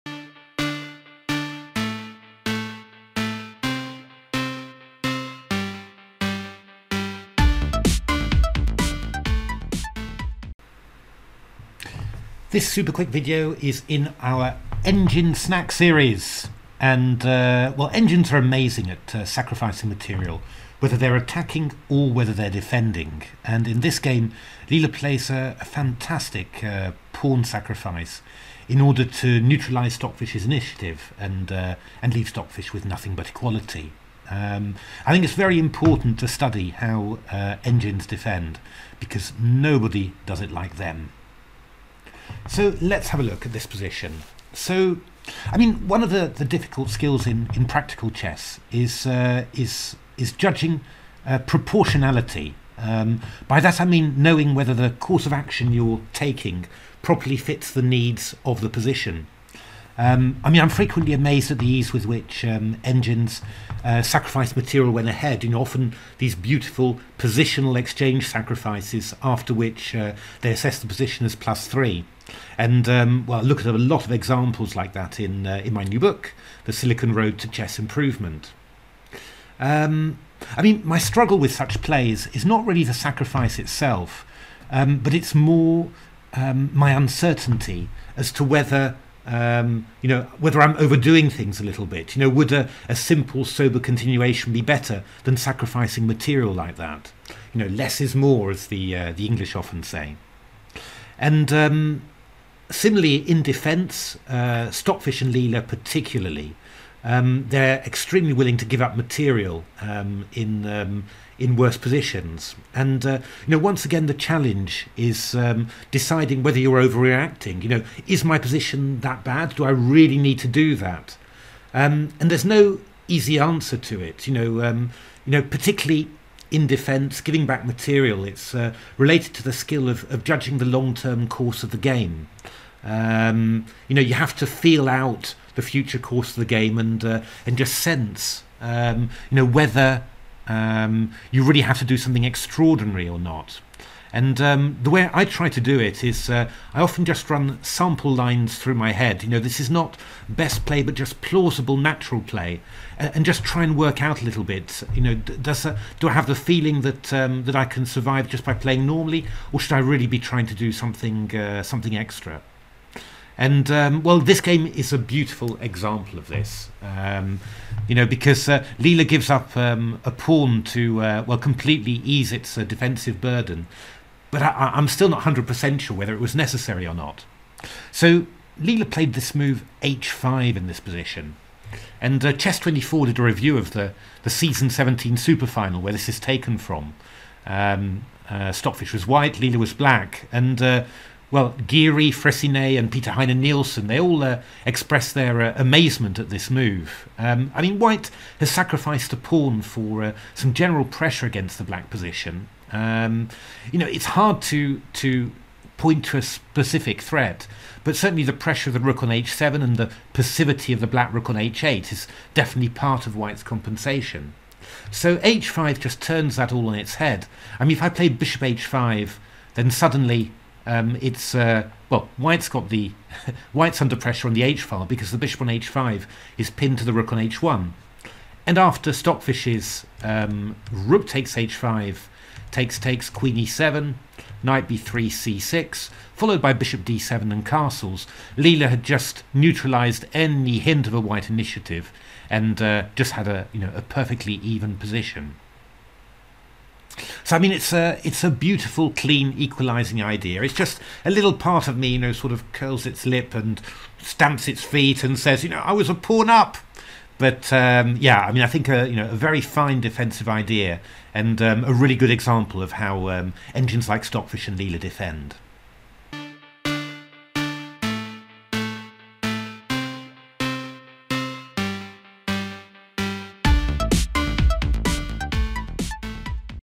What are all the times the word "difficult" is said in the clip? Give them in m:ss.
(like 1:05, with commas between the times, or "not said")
0:46.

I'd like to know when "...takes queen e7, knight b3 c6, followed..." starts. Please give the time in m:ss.
3:52.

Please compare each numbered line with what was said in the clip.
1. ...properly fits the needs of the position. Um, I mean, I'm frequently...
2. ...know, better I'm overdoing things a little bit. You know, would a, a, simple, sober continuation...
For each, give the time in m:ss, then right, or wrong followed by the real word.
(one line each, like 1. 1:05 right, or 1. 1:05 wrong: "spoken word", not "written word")
1. 0:57 right
2. 1:30 wrong: "whether", not "better".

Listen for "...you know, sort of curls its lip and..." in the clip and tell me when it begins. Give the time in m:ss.
4:11.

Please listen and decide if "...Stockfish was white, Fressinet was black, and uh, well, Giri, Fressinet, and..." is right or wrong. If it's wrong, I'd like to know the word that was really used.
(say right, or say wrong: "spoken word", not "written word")
wrong: "Leela", not "Fressinet".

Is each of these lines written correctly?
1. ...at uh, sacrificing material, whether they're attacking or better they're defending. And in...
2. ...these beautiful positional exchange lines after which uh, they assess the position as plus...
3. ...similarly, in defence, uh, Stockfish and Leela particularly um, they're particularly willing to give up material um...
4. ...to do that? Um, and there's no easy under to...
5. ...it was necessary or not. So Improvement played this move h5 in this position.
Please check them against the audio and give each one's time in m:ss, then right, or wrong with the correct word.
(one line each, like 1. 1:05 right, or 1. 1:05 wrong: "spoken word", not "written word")
1. 0:18 wrong: "whether", not "better"
2. 1:06 wrong: "sacrifices", not "lines"
3. 1:42 wrong: "extremely", not "particularly"
4. 2:00 wrong: "answer", not "under"
5. 2:56 wrong: "Leela", not "Improvement".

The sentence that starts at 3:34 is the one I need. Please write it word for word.
So h5 just turns that all on its head.